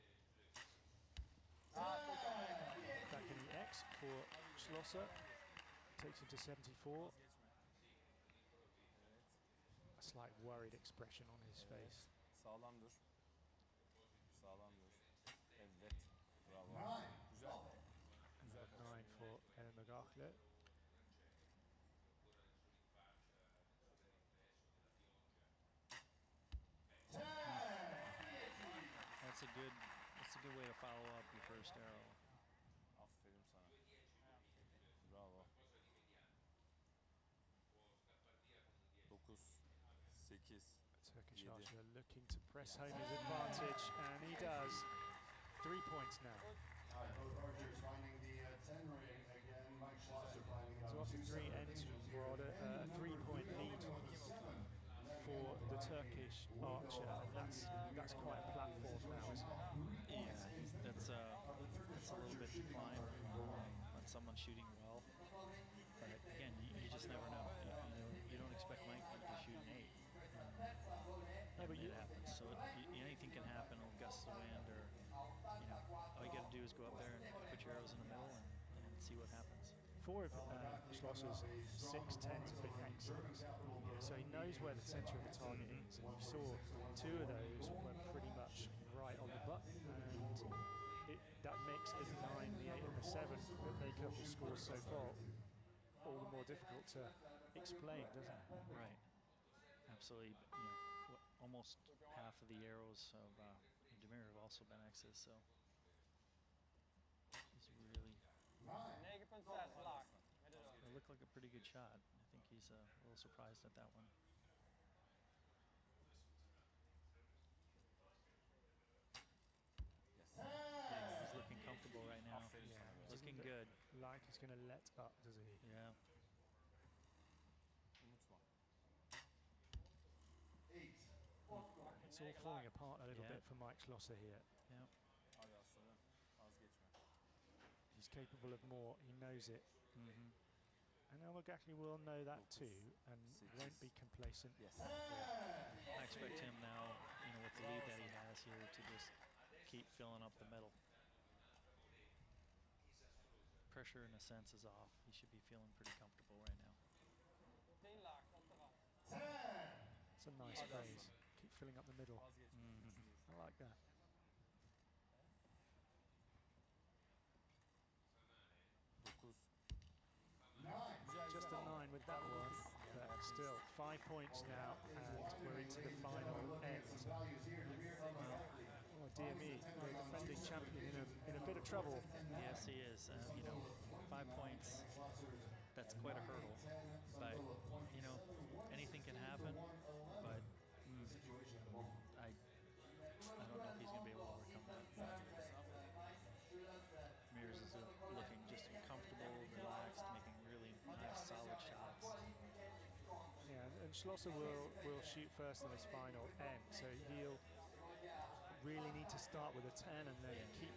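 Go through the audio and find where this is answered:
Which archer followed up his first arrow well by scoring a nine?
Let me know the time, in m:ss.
0:19.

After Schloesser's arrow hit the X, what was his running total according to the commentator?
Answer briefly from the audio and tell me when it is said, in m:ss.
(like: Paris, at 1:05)
74, at 0:06.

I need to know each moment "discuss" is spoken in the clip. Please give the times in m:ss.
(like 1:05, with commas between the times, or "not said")
not said.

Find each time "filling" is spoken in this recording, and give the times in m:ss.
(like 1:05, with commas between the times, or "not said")
2:29, 2:41.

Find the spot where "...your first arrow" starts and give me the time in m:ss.
0:31.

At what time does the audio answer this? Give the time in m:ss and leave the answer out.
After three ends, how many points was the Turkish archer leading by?
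0:52.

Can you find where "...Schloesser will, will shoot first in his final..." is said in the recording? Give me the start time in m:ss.
3:23.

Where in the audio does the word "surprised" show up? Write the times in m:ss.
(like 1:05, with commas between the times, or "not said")
1:53.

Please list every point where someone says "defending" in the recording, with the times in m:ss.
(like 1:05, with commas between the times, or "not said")
2:59.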